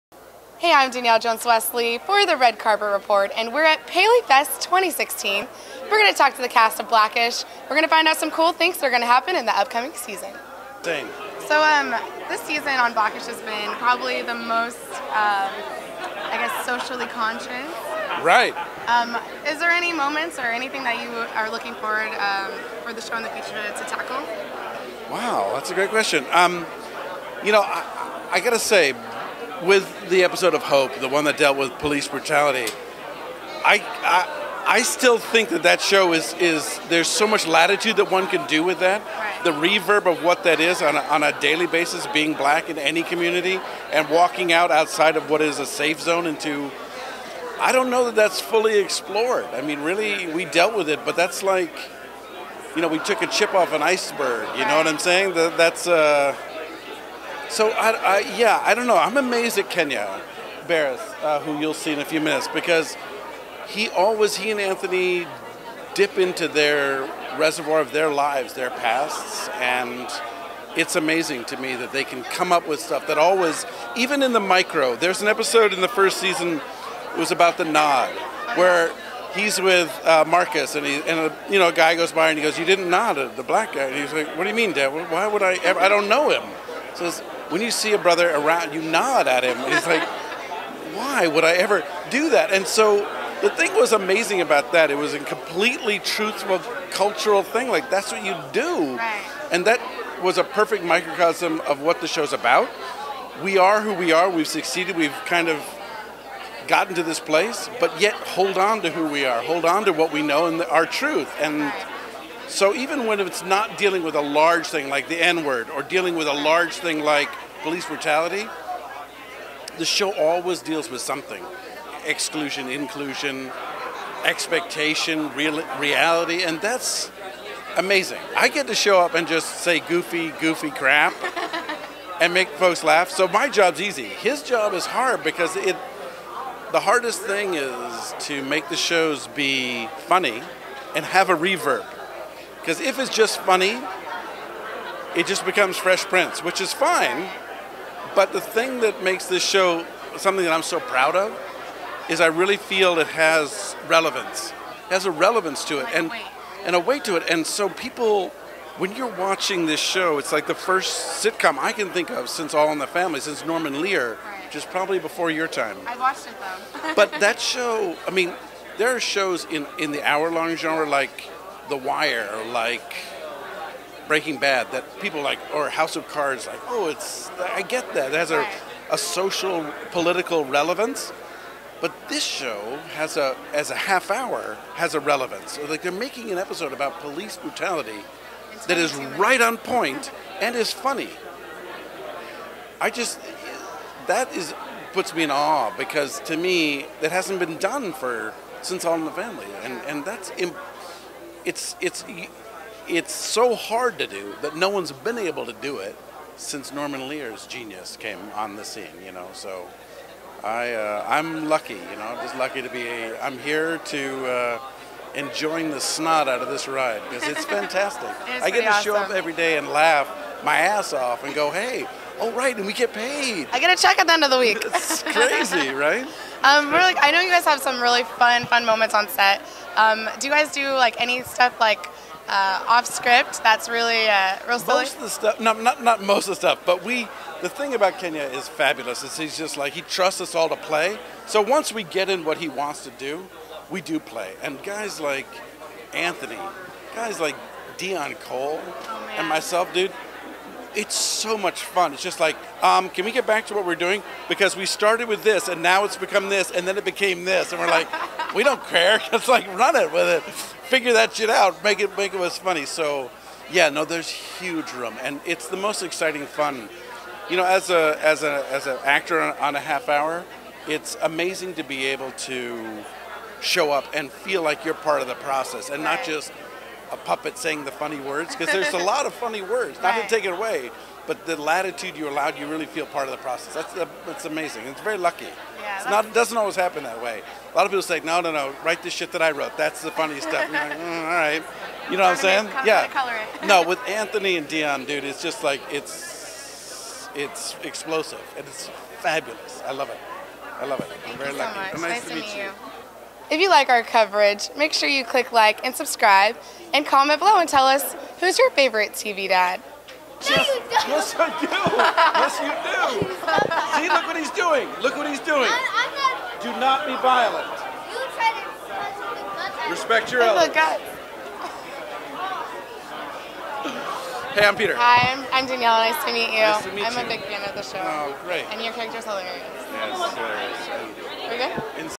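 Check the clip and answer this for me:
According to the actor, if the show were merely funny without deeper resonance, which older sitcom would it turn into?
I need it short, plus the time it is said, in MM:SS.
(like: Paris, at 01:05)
Fresh Prince, at 02:25.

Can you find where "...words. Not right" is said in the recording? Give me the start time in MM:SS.
04:39.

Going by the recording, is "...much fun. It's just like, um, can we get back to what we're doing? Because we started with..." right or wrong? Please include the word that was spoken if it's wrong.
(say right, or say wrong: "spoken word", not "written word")
right.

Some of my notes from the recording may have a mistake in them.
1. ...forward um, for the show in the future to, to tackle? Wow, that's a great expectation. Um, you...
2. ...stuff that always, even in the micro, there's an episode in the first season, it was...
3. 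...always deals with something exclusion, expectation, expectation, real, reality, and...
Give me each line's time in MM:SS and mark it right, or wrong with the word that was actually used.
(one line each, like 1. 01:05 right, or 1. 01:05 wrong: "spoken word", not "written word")
1. 00:21 wrong: "question", not "expectation"
2. 01:12 right
3. 02:00 wrong: "inclusion", not "expectation".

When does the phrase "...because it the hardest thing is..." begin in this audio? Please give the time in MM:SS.
02:15.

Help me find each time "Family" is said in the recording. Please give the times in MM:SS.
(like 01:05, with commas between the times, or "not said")
02:42, 03:19.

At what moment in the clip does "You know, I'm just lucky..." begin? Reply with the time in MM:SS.
03:31.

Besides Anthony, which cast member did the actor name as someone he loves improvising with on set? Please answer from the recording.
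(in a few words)
Deon Cole.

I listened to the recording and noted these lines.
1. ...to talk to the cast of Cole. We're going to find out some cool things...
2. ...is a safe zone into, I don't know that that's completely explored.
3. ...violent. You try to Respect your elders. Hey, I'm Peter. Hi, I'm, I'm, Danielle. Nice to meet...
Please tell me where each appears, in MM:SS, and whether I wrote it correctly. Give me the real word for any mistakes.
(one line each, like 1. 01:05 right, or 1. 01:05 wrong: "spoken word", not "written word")
1. 00:06 wrong: "Blackish", not "Cole"
2. 00:45 wrong: "fully", not "completely"
3. 05:17 right.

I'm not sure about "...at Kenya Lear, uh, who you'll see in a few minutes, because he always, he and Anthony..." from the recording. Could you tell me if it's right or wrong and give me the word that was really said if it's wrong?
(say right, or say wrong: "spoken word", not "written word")
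wrong: "Barris", not "Lear".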